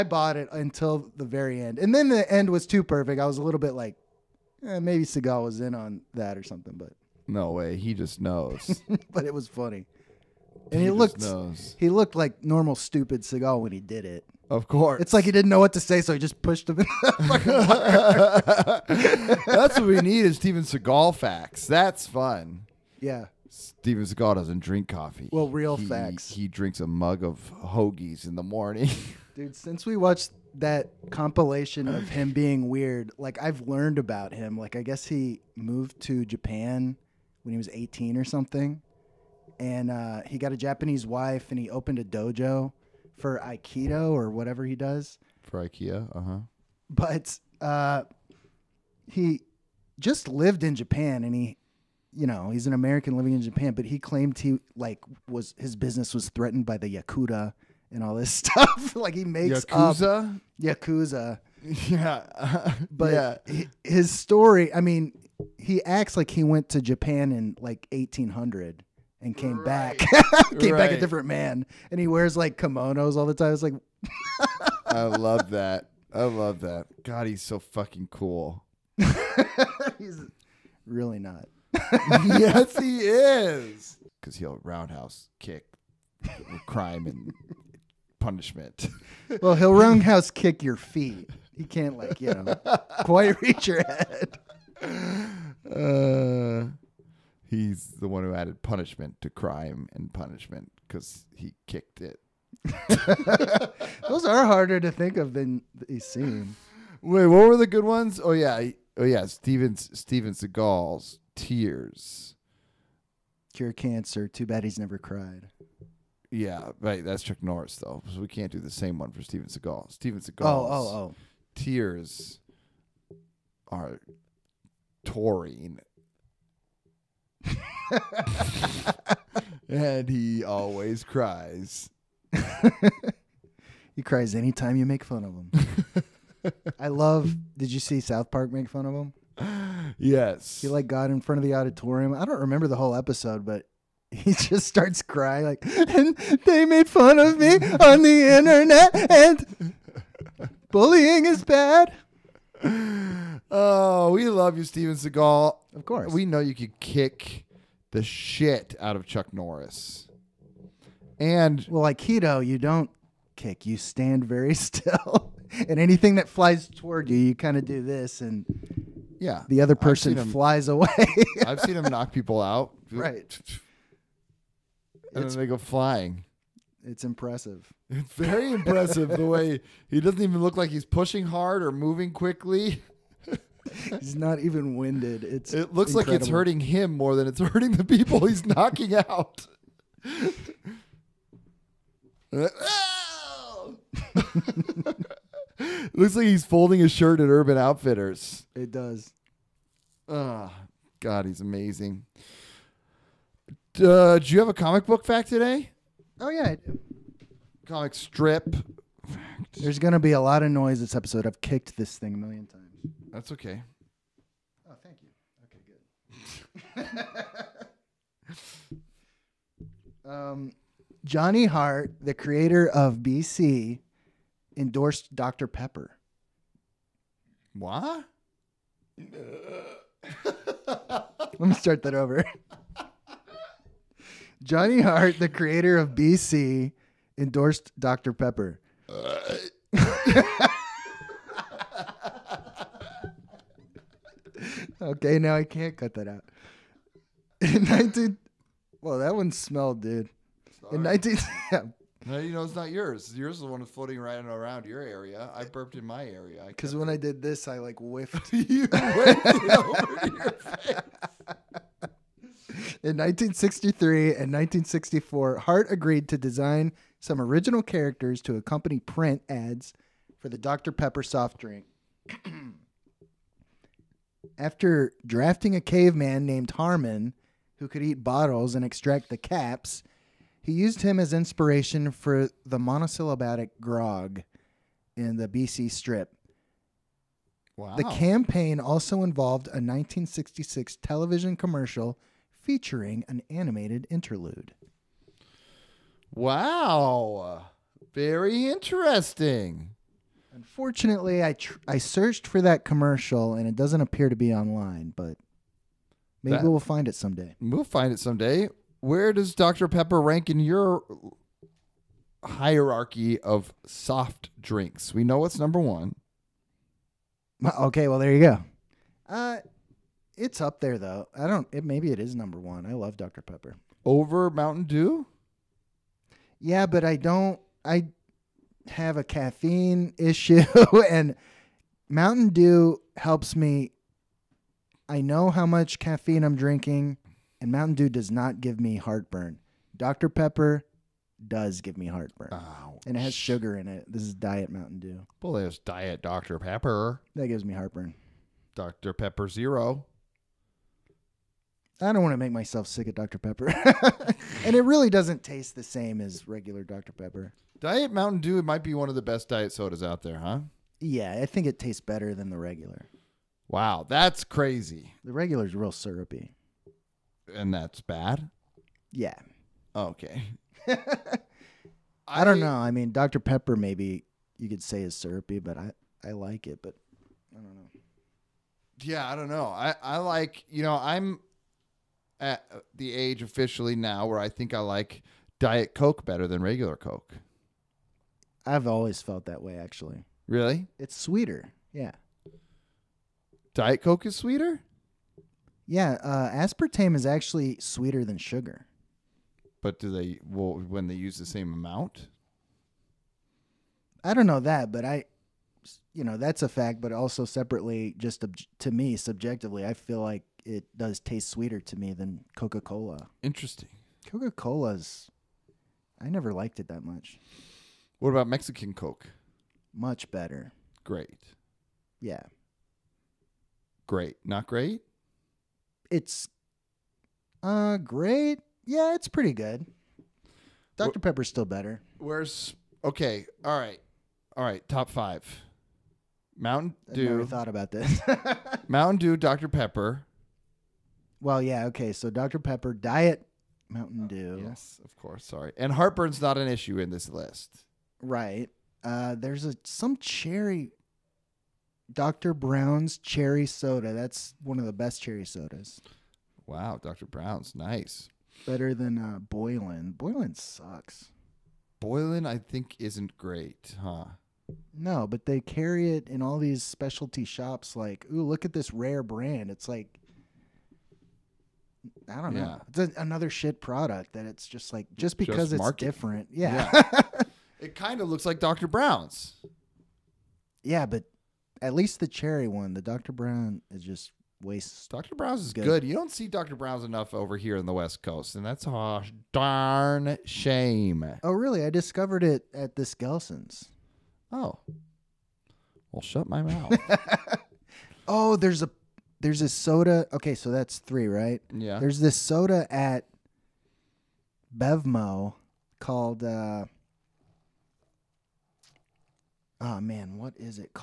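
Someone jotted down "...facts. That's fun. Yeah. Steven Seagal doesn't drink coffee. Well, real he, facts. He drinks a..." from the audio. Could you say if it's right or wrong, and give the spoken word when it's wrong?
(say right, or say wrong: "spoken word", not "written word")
right.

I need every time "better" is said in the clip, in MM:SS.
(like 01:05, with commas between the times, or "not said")
06:01, 06:26, 07:00, 07:11, 07:38.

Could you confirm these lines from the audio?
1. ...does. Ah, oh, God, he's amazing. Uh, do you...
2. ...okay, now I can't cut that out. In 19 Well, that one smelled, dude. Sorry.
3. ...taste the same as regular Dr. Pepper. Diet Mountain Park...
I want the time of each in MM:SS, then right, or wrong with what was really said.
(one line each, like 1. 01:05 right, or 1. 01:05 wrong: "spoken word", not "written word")
1. 03:18 right
2. 04:04 right
3. 05:55 wrong: "Dew", not "Park".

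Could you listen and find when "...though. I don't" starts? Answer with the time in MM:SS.
05:20.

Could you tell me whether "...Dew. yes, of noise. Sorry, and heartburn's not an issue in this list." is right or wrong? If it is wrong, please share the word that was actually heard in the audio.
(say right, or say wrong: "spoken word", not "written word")
wrong: "course", not "noise".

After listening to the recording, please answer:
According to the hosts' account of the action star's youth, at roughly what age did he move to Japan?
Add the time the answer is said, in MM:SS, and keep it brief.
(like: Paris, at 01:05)
18, at 00:37.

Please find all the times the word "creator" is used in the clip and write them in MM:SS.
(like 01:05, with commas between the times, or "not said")
03:42, 03:55.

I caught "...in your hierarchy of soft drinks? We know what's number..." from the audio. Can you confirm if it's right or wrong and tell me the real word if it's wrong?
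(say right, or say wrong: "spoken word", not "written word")
right.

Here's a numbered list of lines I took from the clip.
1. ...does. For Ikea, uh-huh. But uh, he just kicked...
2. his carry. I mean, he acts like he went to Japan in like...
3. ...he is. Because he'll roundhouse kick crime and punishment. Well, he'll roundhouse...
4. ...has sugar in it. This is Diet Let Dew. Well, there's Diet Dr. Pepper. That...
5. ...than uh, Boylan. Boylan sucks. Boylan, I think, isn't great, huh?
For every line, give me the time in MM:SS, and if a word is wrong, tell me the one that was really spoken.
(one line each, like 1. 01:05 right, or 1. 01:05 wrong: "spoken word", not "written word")
1. 00:44 wrong: "lived", not "kicked"
2. 01:03 wrong: "story", not "carry"
3. 01:22 right
4. 05:43 wrong: "Mountain", not "Let"
5. 07:38 right.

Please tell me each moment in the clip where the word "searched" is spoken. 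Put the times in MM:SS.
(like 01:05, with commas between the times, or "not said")
05:01.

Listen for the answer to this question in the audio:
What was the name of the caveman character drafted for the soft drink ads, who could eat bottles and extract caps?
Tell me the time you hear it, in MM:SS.
04:36.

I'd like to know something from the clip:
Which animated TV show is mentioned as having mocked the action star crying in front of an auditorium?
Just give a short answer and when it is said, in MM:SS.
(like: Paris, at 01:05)
South Park, at 02:18.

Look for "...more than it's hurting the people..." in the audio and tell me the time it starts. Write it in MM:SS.
03:06.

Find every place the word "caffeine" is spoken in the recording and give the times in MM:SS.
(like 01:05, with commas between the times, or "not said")
05:29, 05:35.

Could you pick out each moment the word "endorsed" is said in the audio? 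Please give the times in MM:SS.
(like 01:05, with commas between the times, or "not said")
03:44, 03:57.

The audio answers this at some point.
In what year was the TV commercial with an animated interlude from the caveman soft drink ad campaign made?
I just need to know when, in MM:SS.
04:49.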